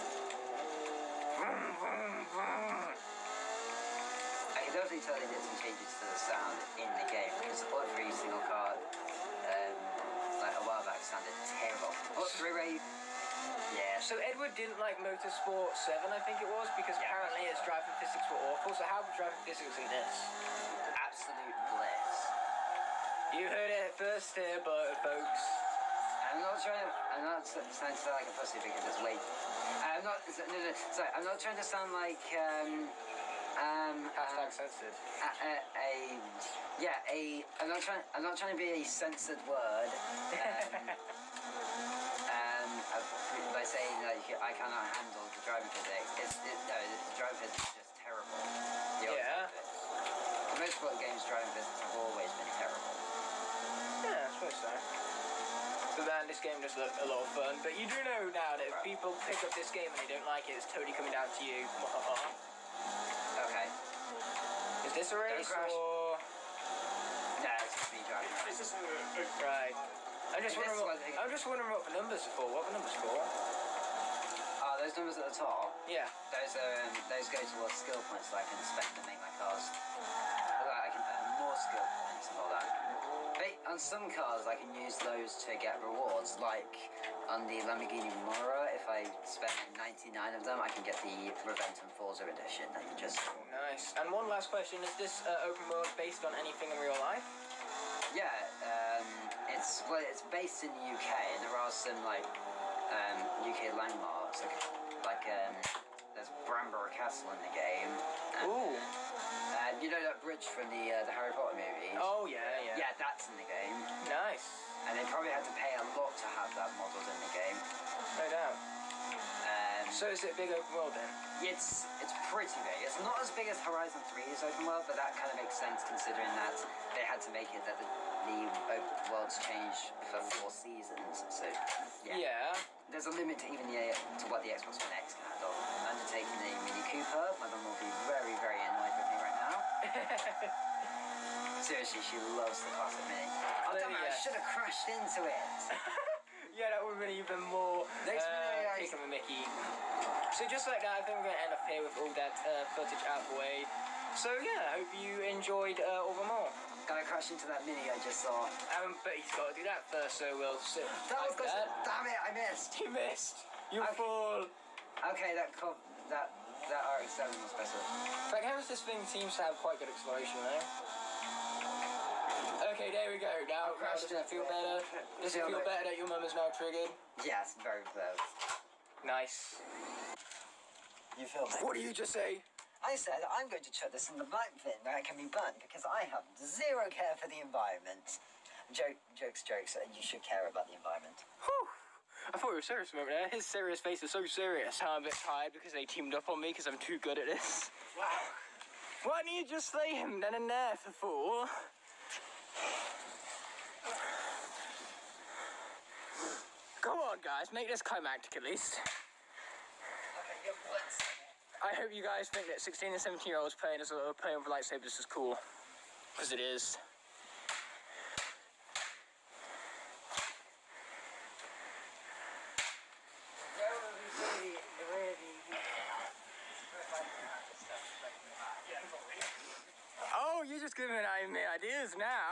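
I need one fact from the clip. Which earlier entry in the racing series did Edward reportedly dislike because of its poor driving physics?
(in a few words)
Motorsport 7.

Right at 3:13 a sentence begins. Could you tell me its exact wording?
His serious face is so serious.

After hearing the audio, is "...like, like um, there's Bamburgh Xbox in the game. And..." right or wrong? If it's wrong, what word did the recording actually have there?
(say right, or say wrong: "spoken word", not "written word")
wrong: "Castle", not "Xbox".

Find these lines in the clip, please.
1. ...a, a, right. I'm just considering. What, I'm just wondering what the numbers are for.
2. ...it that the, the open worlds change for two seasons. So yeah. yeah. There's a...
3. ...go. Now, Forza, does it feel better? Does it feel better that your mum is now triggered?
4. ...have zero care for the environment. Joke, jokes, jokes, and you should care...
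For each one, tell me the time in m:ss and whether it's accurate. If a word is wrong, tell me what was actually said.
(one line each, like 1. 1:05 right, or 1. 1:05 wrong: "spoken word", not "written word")
1. 1:08 wrong: "wondering", not "considering"
2. 2:07 wrong: "four", not "two"
3. 2:53 wrong: "Crash", not "Forza"
4. 3:06 right.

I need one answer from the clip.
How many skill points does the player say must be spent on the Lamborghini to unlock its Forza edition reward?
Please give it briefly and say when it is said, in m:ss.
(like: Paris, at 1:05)
99, at 1:29.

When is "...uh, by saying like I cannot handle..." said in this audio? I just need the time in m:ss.
0:42.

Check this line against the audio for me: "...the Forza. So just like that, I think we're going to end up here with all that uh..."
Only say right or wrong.
wrong.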